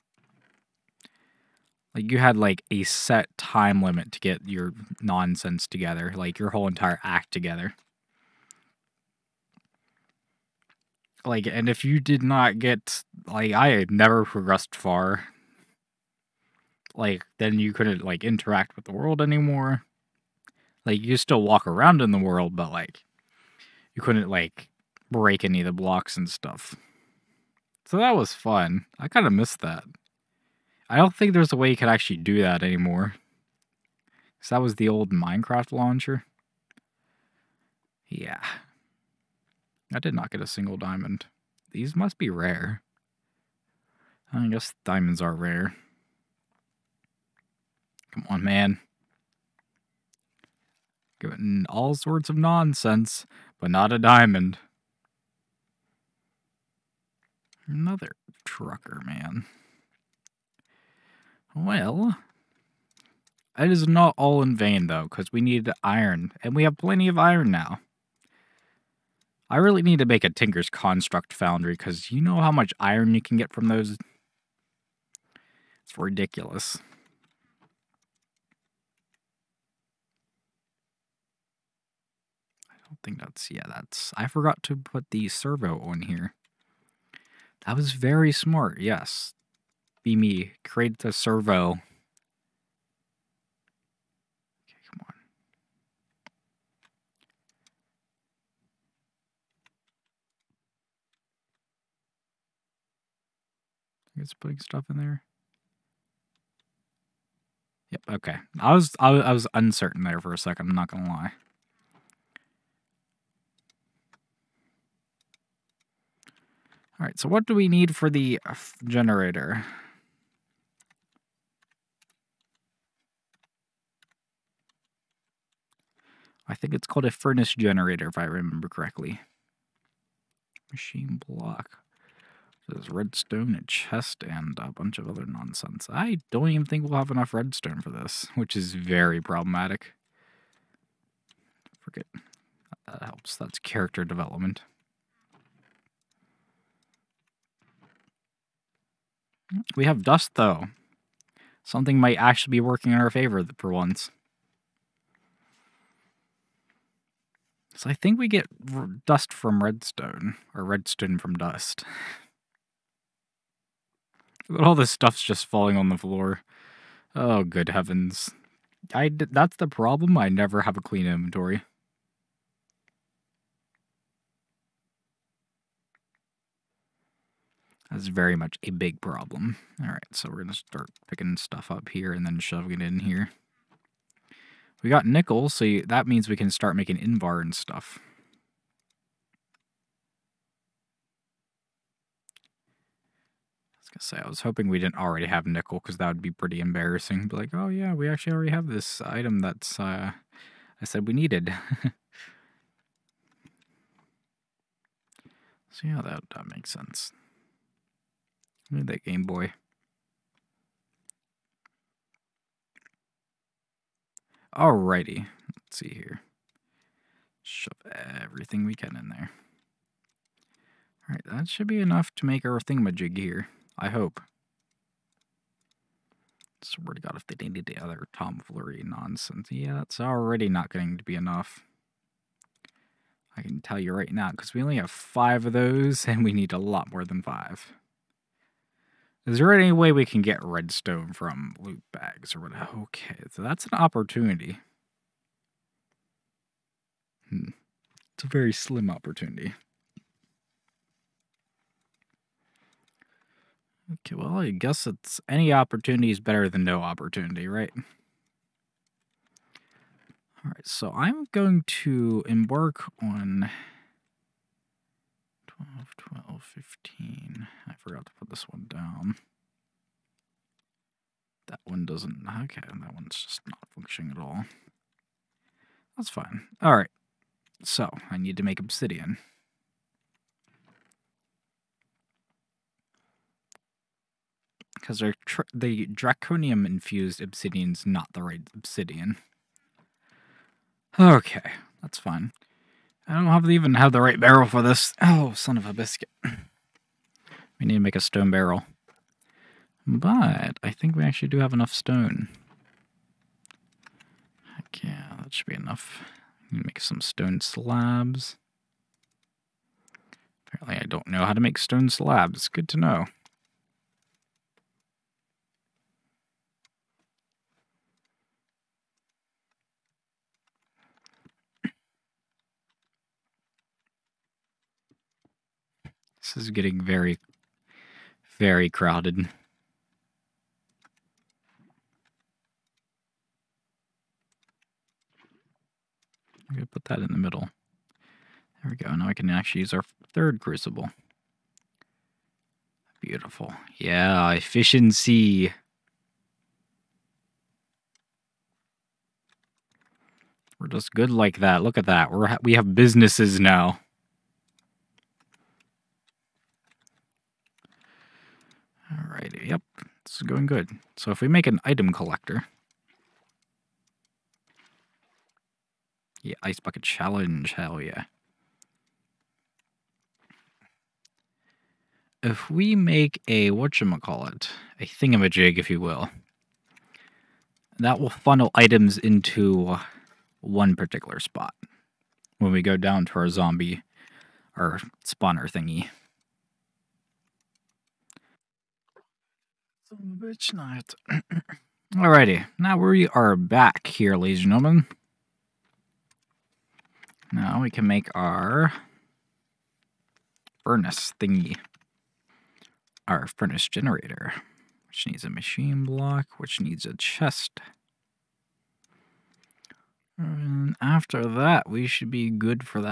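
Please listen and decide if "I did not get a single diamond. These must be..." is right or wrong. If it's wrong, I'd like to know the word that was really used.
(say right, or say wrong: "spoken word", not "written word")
right.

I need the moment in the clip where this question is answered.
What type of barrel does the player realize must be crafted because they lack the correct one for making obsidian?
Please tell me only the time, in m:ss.
4:57.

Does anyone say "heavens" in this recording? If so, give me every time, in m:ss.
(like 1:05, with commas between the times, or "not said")
2:47.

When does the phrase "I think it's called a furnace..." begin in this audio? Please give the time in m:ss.
2:06.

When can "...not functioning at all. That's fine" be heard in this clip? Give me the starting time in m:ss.
4:33.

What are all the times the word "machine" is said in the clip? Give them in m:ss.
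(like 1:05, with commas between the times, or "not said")
2:10, 6:45.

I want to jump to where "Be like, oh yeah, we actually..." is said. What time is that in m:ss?
3:17.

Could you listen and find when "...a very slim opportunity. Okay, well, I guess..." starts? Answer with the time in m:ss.
4:08.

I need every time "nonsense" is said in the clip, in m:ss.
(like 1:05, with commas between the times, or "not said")
0:04, 0:52, 2:15, 3:48.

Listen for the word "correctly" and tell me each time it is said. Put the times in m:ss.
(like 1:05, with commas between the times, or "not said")
2:08.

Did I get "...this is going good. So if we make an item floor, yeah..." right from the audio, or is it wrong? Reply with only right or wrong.
wrong.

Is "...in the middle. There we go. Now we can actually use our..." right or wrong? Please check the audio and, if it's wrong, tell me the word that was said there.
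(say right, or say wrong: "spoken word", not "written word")
right.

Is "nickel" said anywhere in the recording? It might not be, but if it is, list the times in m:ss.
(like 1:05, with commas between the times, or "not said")
3:05, 3:15.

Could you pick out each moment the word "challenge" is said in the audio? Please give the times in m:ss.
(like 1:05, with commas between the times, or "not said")
6:06.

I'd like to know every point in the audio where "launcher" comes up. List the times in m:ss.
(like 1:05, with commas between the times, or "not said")
0:35.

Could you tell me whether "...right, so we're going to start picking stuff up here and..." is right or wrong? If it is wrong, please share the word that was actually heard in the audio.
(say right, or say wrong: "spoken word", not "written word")
right.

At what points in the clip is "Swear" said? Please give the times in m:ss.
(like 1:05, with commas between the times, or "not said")
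3:46.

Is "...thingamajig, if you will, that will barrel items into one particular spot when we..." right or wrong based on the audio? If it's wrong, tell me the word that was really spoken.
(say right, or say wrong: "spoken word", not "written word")
wrong: "funnel", not "barrel".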